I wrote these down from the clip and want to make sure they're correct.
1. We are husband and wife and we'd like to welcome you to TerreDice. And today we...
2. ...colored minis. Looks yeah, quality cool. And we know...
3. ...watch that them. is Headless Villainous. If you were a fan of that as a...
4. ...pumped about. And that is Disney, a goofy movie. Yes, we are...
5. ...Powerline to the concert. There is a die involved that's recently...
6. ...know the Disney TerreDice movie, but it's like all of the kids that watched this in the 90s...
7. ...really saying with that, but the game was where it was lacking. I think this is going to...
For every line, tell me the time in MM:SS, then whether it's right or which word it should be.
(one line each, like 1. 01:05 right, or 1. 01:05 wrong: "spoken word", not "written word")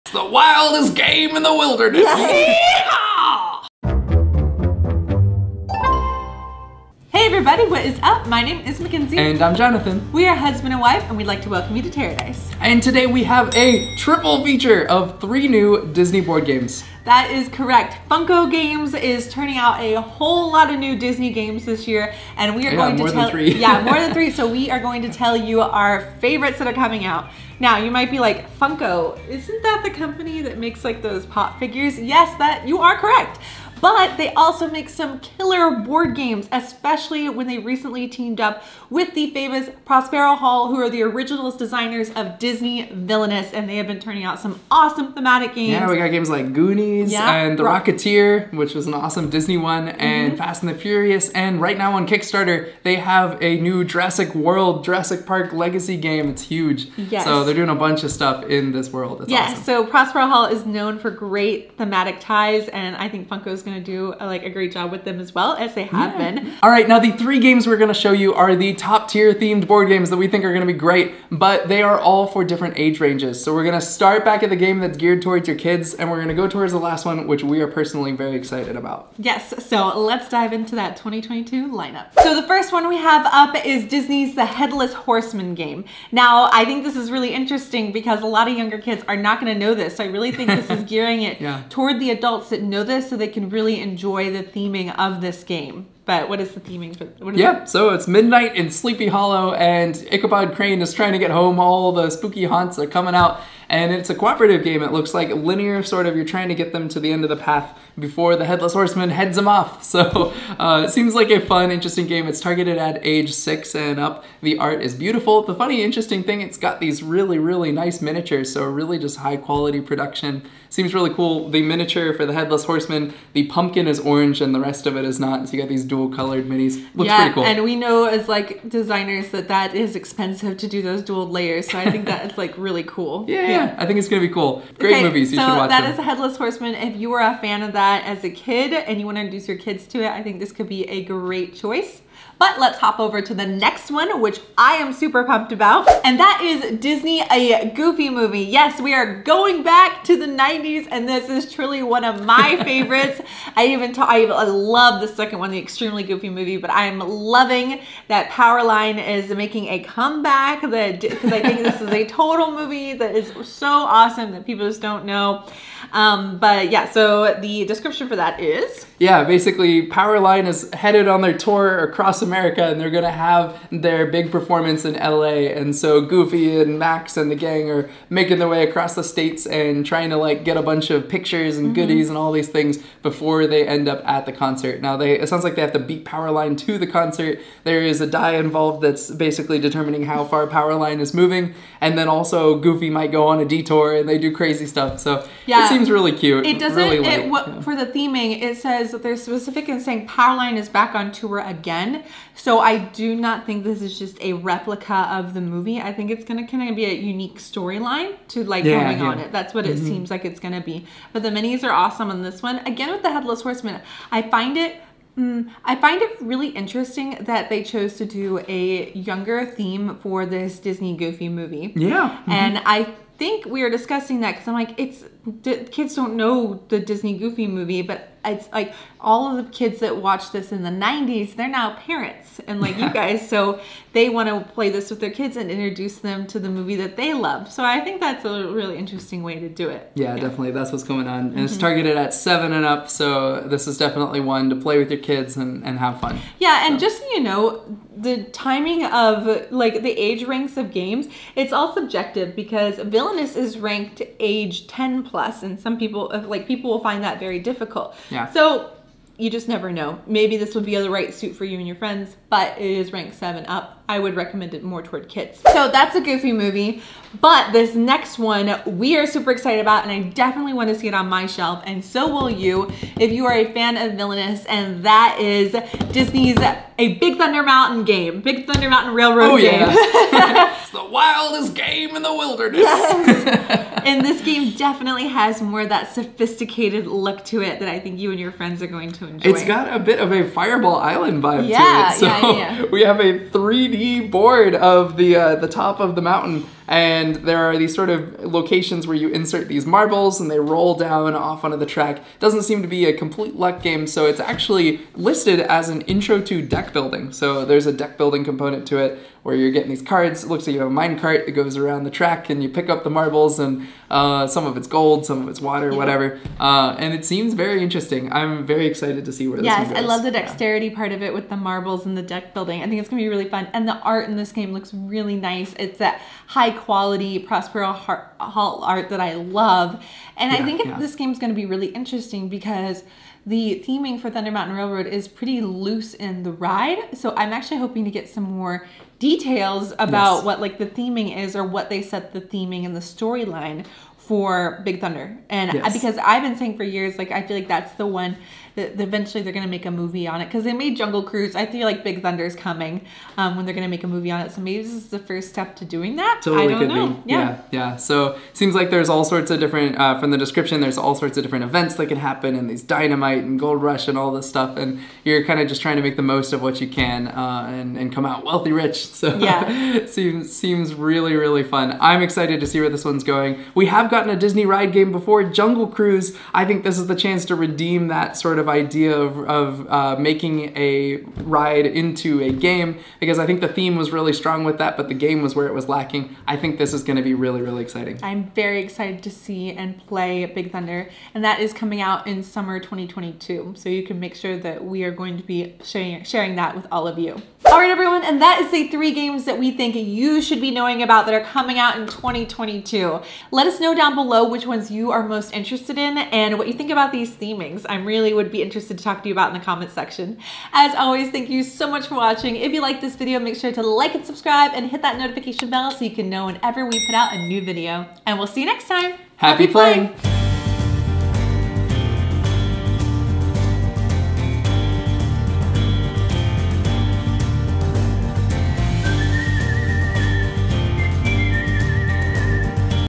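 1. 00:10 right
2. 02:06 wrong: "pretty", not "quality"
3. 02:15 wrong: "Horseman", not "Villainous"
4. 02:25 right
5. 03:06 wrong: "basically", not "recently"
6. 03:46 wrong: "Goofy", not "TerreDice"
7. 06:23 wrong: "strong", not "saying".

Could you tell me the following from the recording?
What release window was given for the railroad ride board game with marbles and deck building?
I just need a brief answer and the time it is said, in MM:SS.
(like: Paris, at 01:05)
summer 2022, at 06:32.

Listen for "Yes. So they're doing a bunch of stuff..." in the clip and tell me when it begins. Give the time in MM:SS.
00:56.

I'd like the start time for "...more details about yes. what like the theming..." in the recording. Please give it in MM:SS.
05:38.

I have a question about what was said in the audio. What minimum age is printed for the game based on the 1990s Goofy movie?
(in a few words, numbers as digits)
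7.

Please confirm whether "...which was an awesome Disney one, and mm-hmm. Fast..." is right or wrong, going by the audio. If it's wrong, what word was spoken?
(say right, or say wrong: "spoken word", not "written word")
right.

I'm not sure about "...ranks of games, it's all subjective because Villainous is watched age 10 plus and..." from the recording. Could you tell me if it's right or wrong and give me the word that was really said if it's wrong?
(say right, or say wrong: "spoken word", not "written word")
wrong: "ranked", not "watched".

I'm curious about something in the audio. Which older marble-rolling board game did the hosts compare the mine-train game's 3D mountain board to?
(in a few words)
Fireball Island.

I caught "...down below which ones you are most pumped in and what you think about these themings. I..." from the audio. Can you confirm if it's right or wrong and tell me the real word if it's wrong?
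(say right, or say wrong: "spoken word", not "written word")
wrong: "interested", not "pumped".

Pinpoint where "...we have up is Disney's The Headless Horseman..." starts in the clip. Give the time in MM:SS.
01:22.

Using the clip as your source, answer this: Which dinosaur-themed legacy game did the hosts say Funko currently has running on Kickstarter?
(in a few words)
Jurassic World, Jurassic Park Legacy.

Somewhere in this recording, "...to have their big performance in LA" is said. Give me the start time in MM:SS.
02:53.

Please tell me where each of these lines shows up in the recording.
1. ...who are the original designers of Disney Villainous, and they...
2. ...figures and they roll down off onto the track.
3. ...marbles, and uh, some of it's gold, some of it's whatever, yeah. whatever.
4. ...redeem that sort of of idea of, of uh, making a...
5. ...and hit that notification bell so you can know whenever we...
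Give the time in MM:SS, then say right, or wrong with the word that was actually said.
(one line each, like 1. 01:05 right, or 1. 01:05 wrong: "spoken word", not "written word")
1. 00:40 right
2. 04:59 wrong: "marbles", not "figures"
3. 05:12 wrong: "water", not "whatever"
4. 06:17 right
5. 06:54 right.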